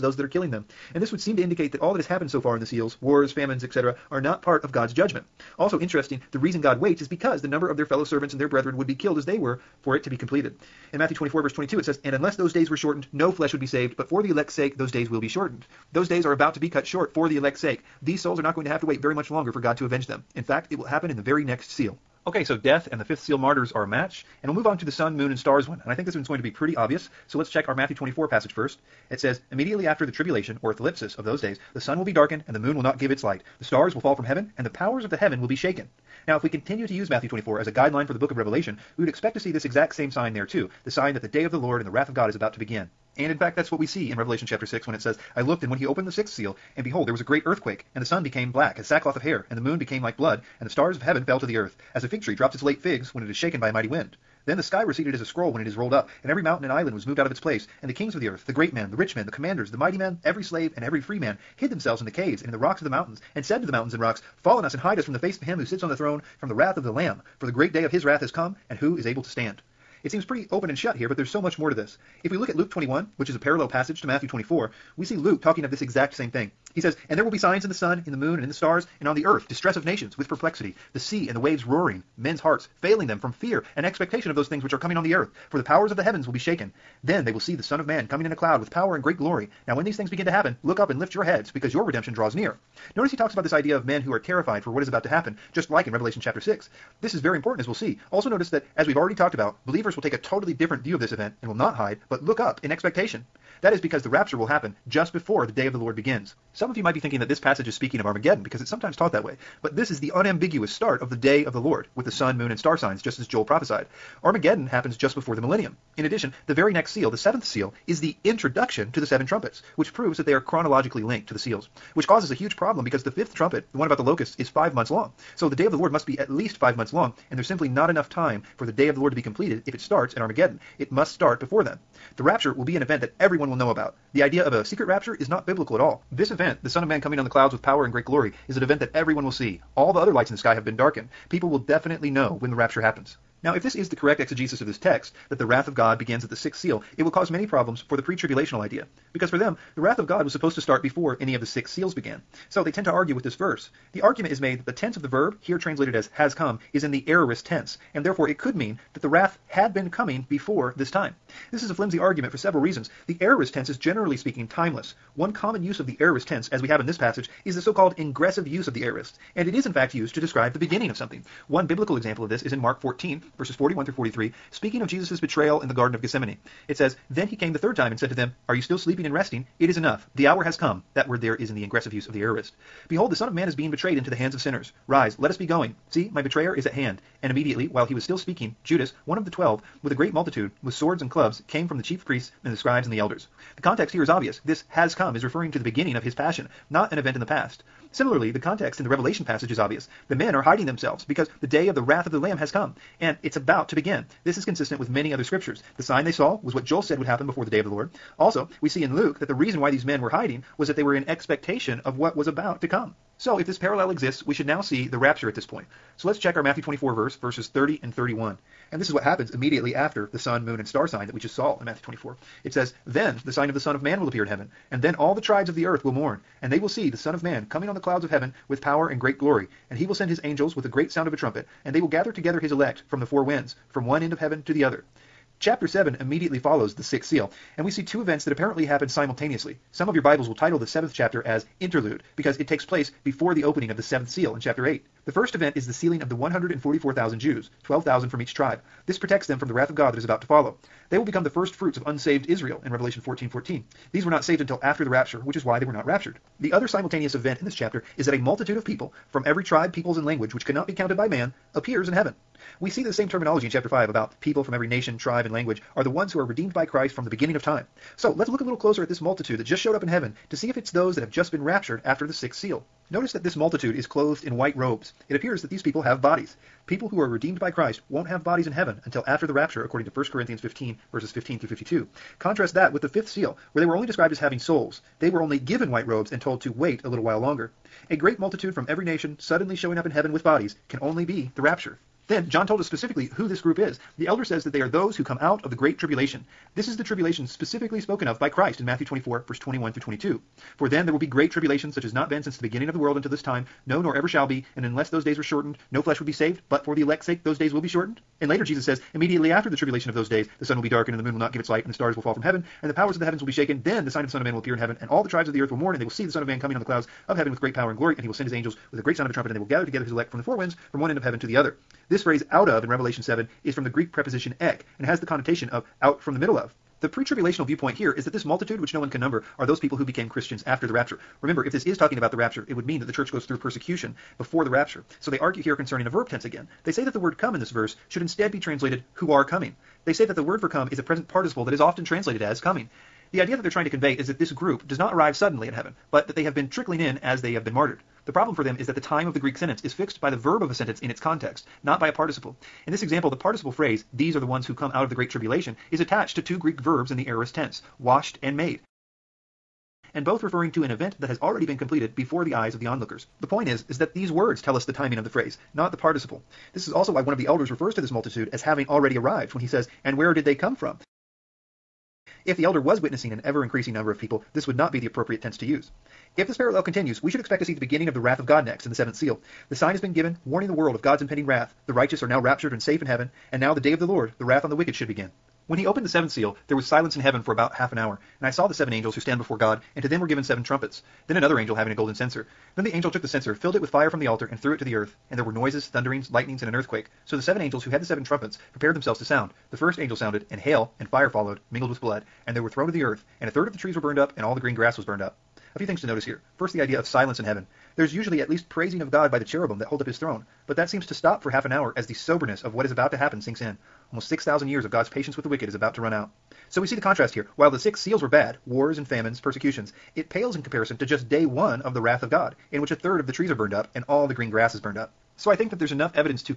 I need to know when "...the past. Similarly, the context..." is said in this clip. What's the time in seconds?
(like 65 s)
197 s.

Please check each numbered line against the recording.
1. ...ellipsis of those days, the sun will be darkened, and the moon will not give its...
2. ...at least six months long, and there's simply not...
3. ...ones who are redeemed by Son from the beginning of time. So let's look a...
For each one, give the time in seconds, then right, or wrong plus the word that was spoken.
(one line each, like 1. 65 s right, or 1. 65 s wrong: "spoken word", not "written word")
1. 30 s right
2. 126 s wrong: "five", not "six"
3. 265 s wrong: "Christ", not "Son".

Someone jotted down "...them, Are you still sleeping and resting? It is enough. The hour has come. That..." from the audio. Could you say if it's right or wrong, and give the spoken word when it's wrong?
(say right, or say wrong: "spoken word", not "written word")
right.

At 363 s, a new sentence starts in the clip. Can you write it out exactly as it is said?
The point is is that these words tell us the timing of the phrase, not the participle.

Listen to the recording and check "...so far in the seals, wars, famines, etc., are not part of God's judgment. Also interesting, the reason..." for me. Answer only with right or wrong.
right.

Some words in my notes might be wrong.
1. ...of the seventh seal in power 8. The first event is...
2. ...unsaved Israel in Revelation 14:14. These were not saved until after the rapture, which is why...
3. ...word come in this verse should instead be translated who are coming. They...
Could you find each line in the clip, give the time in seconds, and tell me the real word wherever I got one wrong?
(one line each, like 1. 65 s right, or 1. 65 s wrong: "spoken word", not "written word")
1. 243 s wrong: "chapter", not "power"
2. 251 s right
3. 336 s right.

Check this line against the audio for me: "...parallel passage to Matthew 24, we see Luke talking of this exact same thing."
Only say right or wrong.
right.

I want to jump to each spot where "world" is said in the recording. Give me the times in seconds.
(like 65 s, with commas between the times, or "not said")
302 s, 380 s.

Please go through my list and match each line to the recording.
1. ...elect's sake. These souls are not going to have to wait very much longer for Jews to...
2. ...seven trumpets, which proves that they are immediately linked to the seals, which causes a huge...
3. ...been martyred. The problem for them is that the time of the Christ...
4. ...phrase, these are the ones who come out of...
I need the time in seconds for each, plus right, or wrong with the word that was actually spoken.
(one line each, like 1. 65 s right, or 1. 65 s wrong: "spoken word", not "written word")
1. 17 s wrong: "God", not "Jews"
2. 119 s wrong: "chronologically", not "immediately"
3. 347 s wrong: "Greek", not "Christ"
4. 353 s right.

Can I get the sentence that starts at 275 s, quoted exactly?
It appears that these people have bodies.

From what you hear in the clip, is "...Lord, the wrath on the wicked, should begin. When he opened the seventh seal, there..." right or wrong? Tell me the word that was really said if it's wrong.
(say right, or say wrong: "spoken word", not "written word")
right.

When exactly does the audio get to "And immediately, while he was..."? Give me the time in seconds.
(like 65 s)
187 s.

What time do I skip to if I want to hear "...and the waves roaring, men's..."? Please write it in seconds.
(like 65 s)
81 s.